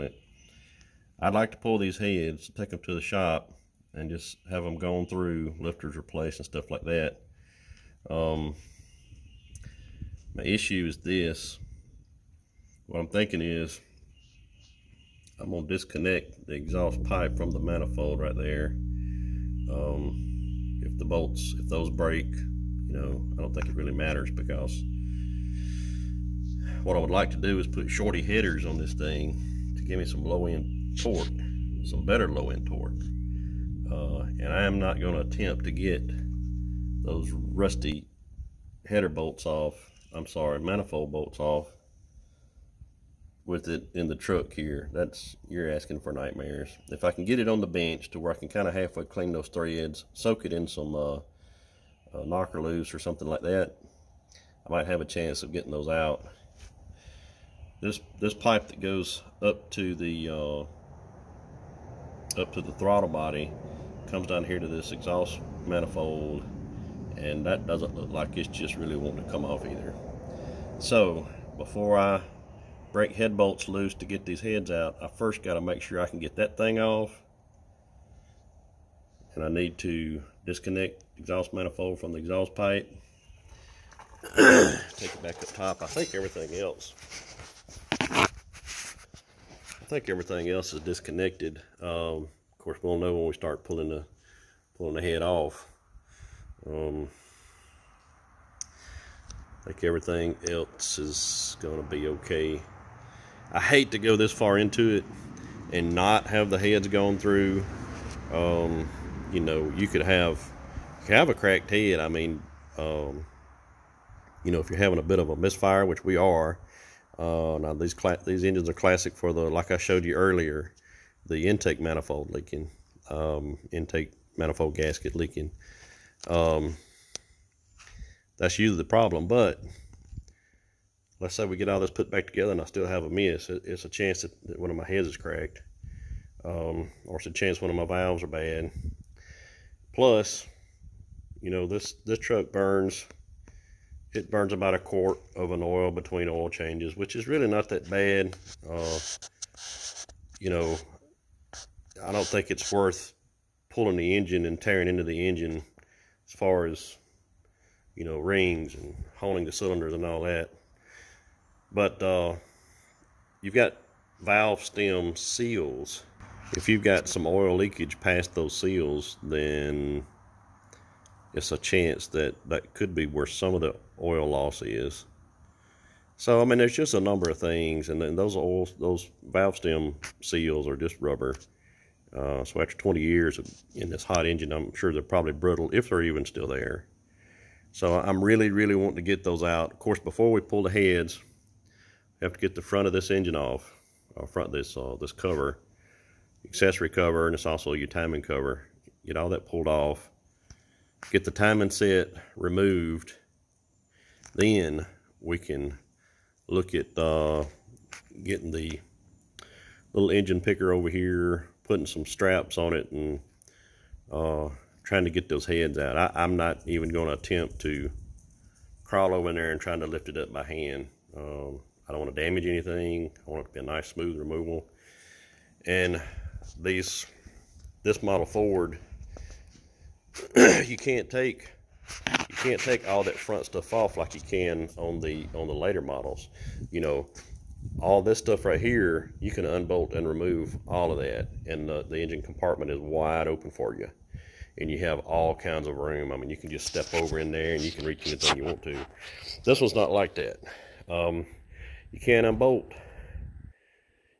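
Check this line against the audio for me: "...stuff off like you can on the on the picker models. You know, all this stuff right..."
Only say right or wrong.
wrong.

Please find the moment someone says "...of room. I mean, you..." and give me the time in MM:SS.
04:05.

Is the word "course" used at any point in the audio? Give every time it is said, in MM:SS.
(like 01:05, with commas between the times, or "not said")
01:32, 03:09.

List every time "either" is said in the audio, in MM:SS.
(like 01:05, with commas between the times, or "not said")
01:09.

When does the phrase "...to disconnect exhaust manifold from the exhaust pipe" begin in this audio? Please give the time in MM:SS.
01:19.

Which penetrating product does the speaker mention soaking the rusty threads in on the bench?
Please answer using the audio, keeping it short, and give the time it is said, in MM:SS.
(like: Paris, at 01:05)
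Knock'er Loose, at 00:52.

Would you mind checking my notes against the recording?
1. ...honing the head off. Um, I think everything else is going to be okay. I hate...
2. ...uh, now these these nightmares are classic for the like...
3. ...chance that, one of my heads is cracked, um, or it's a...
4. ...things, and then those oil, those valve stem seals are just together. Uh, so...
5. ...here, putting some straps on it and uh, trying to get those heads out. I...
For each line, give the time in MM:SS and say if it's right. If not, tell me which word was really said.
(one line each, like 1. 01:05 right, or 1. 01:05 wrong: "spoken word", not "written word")
1. 01:34 wrong: "pulling", not "honing"
2. 01:57 wrong: "engines", not "nightmares"
3. 02:13 right
4. 02:57 wrong: "rubber", not "together"
5. 03:30 right.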